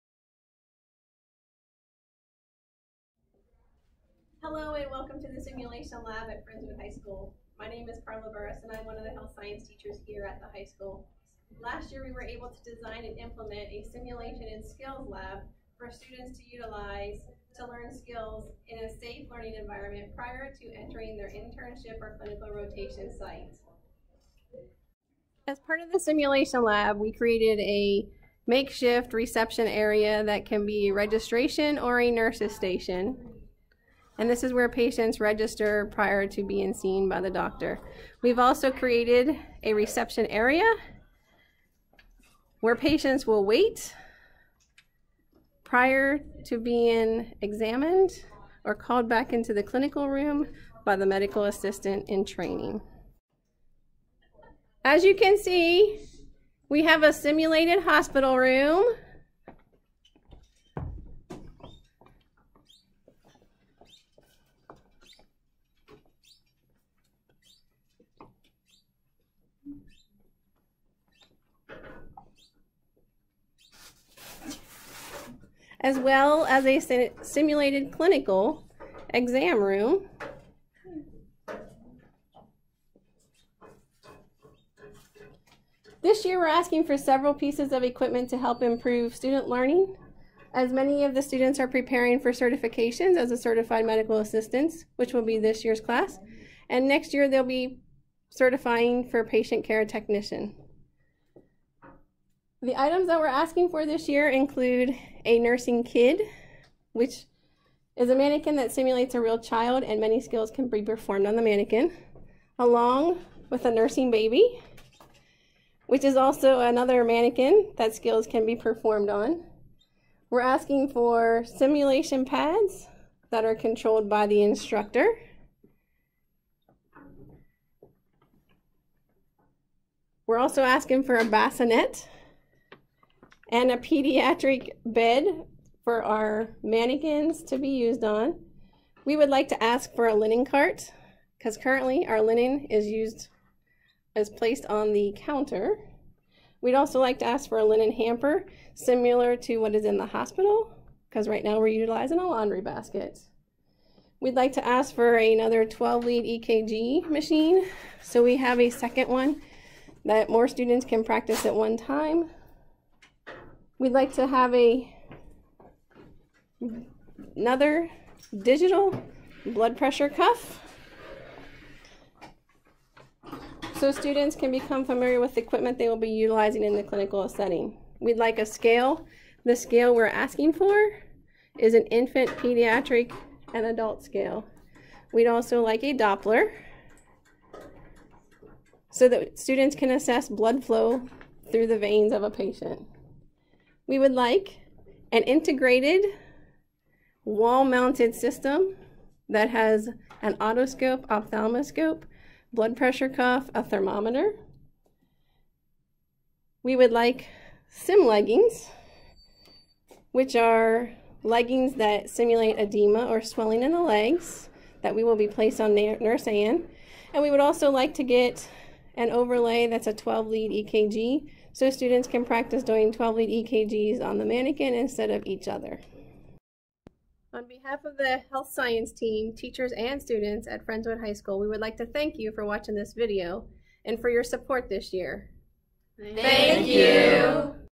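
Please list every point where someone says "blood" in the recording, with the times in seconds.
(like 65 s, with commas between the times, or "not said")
169 s, 190 s, 202 s.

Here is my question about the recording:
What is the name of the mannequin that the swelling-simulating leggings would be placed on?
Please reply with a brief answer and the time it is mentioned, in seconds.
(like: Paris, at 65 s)
Nurse Anne, at 215 s.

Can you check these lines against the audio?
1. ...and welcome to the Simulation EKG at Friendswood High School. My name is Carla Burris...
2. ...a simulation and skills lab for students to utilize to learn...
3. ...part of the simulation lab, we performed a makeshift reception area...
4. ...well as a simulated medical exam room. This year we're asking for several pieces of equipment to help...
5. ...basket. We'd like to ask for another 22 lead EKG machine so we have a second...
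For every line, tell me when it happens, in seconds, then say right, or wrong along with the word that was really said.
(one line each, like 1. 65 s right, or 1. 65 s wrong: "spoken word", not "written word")
1. 4 s wrong: "Lab", not "EKG"
2. 13 s right
3. 25 s wrong: "created", not "performed"
4. 75 s wrong: "clinical", not "medical"
5. 152 s wrong: "12", not "22".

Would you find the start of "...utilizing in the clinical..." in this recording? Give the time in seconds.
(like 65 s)
176 s.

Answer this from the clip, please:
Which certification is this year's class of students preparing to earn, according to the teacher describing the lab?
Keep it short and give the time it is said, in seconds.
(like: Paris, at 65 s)
Certified medical assistant, at 93 s.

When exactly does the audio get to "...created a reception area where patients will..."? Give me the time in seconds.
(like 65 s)
38 s.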